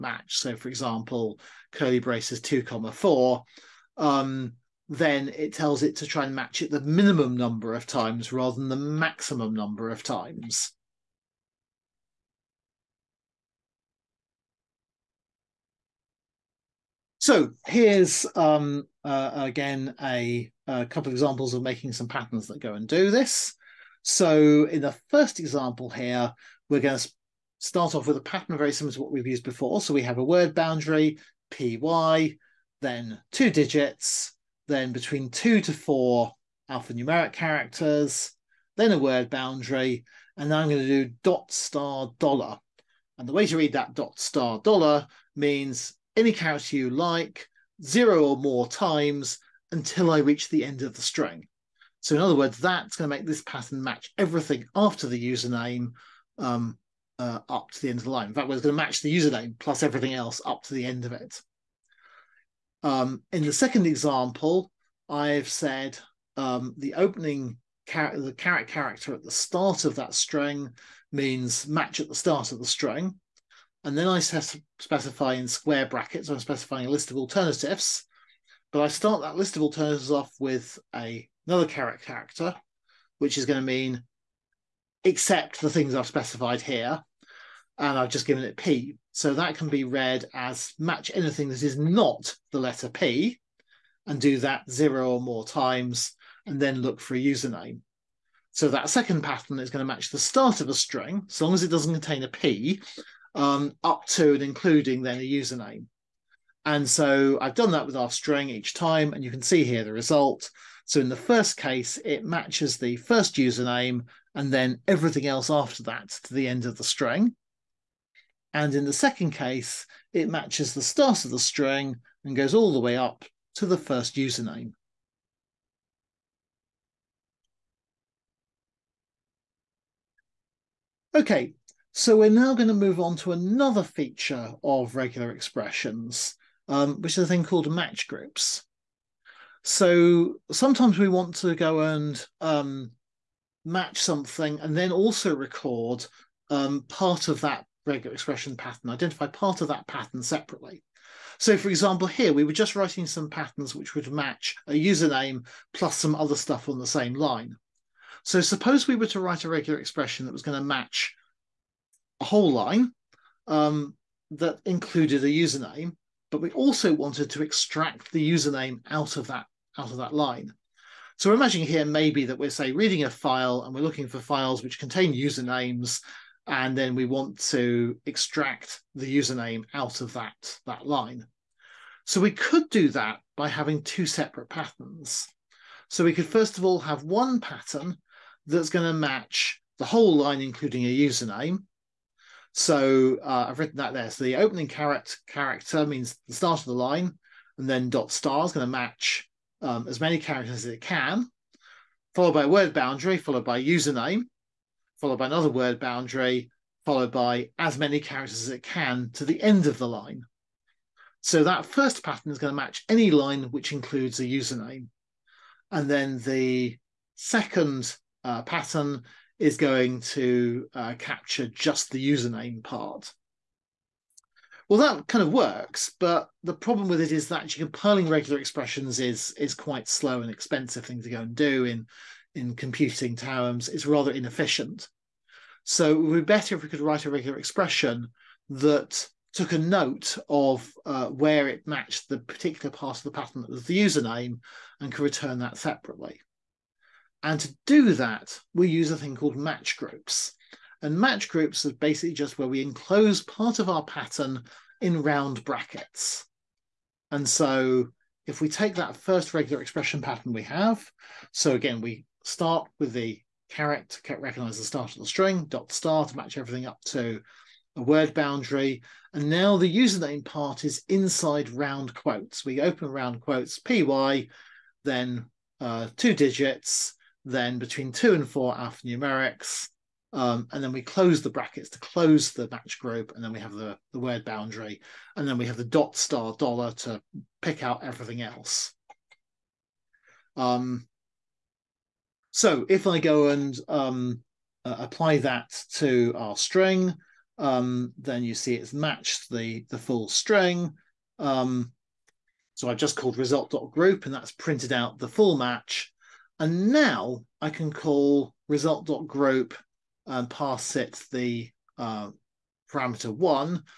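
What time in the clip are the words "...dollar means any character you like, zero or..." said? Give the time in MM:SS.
00:44.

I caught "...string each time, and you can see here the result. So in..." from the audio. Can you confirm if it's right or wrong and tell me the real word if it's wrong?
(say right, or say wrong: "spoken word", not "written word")
right.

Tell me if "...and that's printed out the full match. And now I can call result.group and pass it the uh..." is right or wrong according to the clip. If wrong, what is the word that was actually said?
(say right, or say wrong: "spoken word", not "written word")
right.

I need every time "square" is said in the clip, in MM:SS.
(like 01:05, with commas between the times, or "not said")
01:15.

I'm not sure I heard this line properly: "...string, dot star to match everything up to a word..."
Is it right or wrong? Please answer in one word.
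right.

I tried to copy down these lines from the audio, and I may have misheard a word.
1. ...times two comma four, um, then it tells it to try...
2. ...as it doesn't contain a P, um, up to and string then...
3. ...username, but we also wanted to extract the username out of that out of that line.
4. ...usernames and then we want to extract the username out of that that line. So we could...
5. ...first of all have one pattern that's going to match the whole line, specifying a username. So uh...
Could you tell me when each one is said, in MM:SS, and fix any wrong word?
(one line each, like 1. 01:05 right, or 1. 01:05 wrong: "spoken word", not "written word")
1. 00:02 wrong: "braces", not "times"
2. 01:41 wrong: "including", not "string"
3. 02:45 right
4. 02:55 right
5. 03:06 wrong: "including", not "specifying".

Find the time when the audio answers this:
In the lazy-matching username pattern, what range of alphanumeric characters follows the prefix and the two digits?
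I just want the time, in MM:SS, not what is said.
00:34.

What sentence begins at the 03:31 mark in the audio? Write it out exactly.
So that first pattern is going to match any line which includes a username.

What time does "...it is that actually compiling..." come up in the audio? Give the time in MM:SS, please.
03:47.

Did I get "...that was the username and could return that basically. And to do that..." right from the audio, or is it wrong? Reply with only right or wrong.
wrong.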